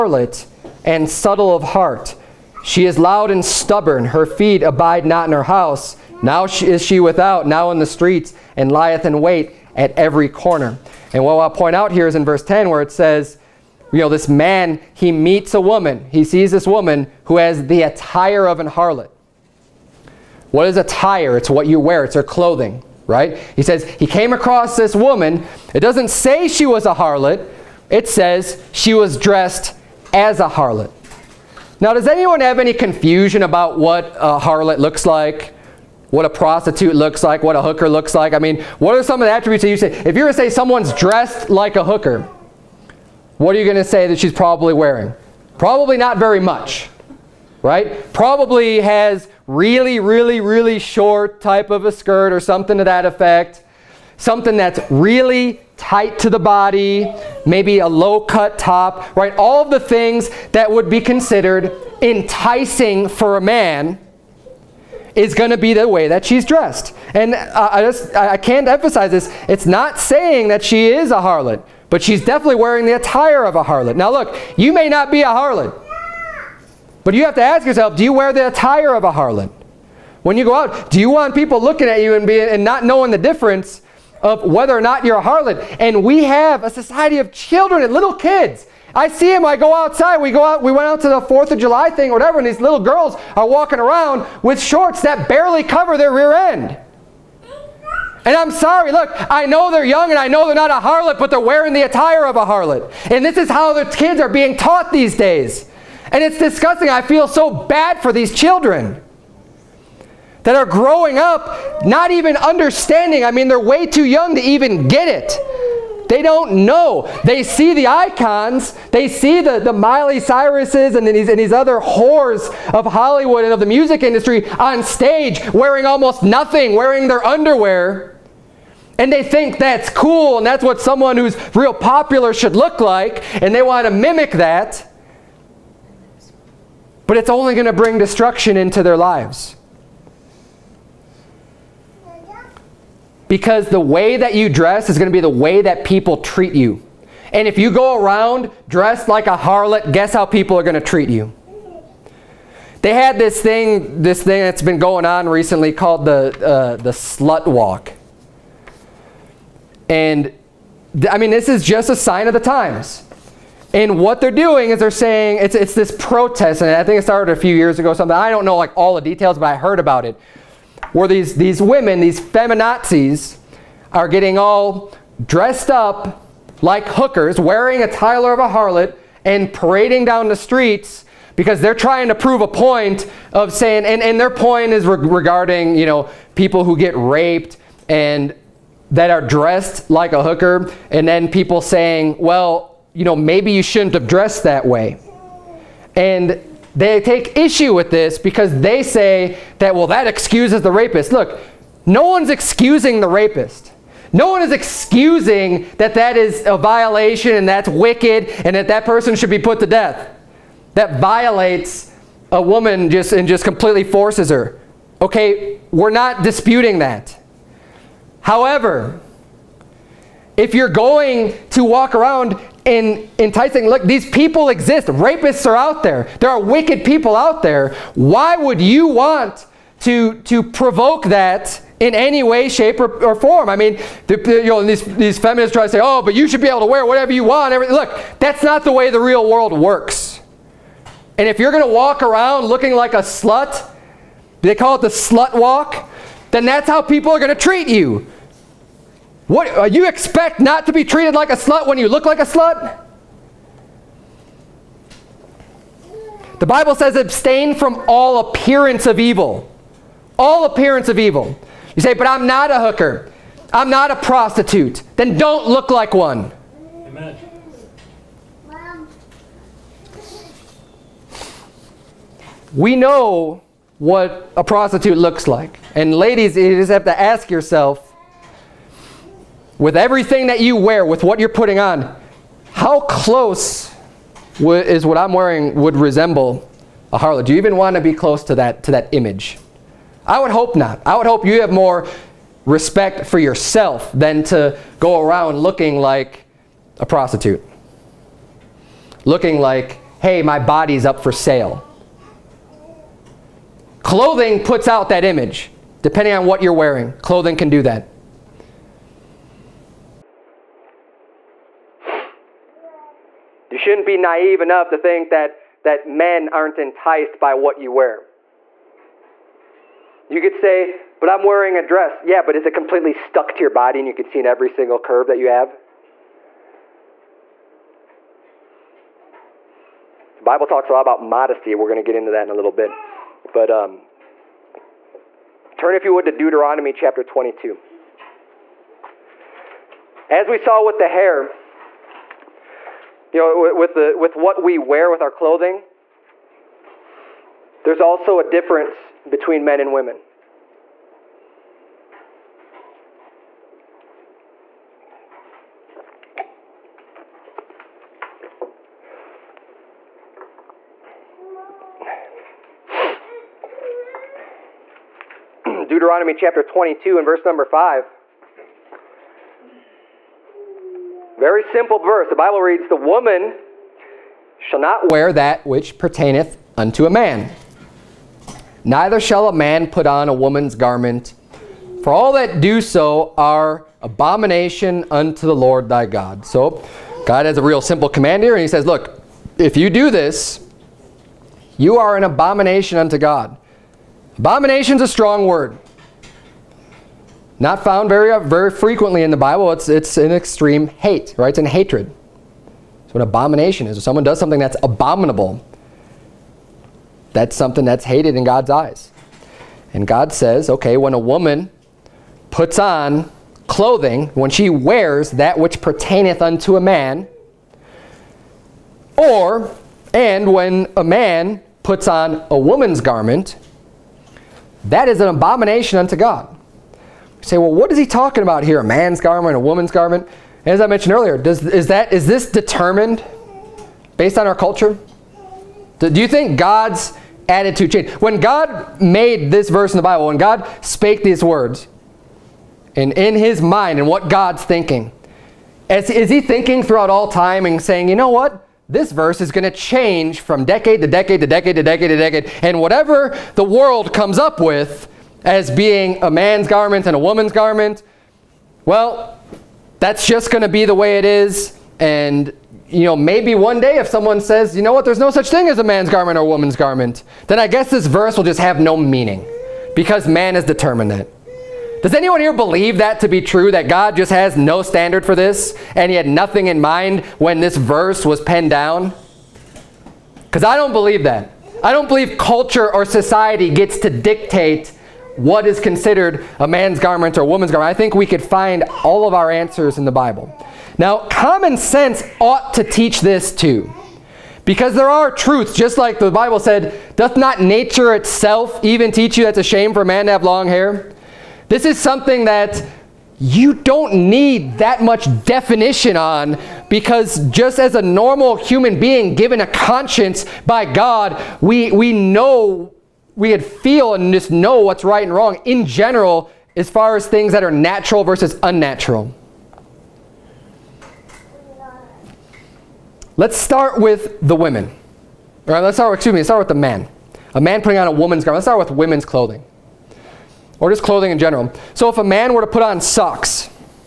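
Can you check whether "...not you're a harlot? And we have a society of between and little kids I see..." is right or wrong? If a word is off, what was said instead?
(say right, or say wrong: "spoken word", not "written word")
wrong: "children", not "between".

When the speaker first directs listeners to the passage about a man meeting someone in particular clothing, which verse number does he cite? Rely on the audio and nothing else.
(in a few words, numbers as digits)
Verse 10.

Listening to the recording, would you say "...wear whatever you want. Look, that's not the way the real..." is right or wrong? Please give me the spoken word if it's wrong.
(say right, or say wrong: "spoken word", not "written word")
right.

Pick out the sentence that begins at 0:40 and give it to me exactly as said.
If you were to say someone's dressed like a hooker, what are you going to say that she's probably wearing?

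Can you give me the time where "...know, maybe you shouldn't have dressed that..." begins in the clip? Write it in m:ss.
3:13.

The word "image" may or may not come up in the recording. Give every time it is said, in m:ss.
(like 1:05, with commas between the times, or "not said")
4:48, 5:05.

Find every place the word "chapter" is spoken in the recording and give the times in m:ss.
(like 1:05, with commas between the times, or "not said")
5:36, 6:06.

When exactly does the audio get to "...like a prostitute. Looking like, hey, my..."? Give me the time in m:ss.
4:55.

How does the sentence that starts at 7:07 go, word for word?
You say, well, what is he talking about here?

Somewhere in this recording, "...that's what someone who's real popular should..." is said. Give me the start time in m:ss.
2:10.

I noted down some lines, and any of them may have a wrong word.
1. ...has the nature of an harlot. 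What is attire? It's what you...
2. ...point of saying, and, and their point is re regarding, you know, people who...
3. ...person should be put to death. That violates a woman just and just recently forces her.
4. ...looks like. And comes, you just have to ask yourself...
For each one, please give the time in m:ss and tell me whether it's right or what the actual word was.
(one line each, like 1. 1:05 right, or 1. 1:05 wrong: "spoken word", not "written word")
1. 0:17 wrong: "attire", not "nature"
2. 3:02 right
3. 3:28 wrong: "completely", not "recently"
4. 4:34 wrong: "ladies", not "comes".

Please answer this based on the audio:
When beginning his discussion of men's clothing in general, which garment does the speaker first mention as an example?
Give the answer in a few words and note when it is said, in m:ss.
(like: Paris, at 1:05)
Socks, at 8:52.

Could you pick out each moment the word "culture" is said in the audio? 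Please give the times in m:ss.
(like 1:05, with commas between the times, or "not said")
7:14, 8:02.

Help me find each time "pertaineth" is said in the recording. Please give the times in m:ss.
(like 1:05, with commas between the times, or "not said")
6:15, 6:55.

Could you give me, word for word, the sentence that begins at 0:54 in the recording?
Something that's really tight to the body, maybe a low cut top, right?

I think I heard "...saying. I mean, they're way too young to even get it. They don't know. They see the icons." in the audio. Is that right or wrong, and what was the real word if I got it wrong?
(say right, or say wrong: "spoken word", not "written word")
wrong: "understanding", not "saying".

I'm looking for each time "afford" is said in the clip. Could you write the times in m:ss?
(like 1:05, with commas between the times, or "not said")
not said.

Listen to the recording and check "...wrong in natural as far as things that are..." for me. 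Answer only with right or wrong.
wrong.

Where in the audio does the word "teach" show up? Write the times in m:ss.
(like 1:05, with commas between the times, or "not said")
8:12, 8:18.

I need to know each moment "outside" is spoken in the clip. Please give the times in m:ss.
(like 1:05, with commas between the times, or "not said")
1:29.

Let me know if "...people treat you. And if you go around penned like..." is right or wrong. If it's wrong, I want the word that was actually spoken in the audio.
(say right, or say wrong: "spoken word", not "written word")
wrong: "dressed", not "penned".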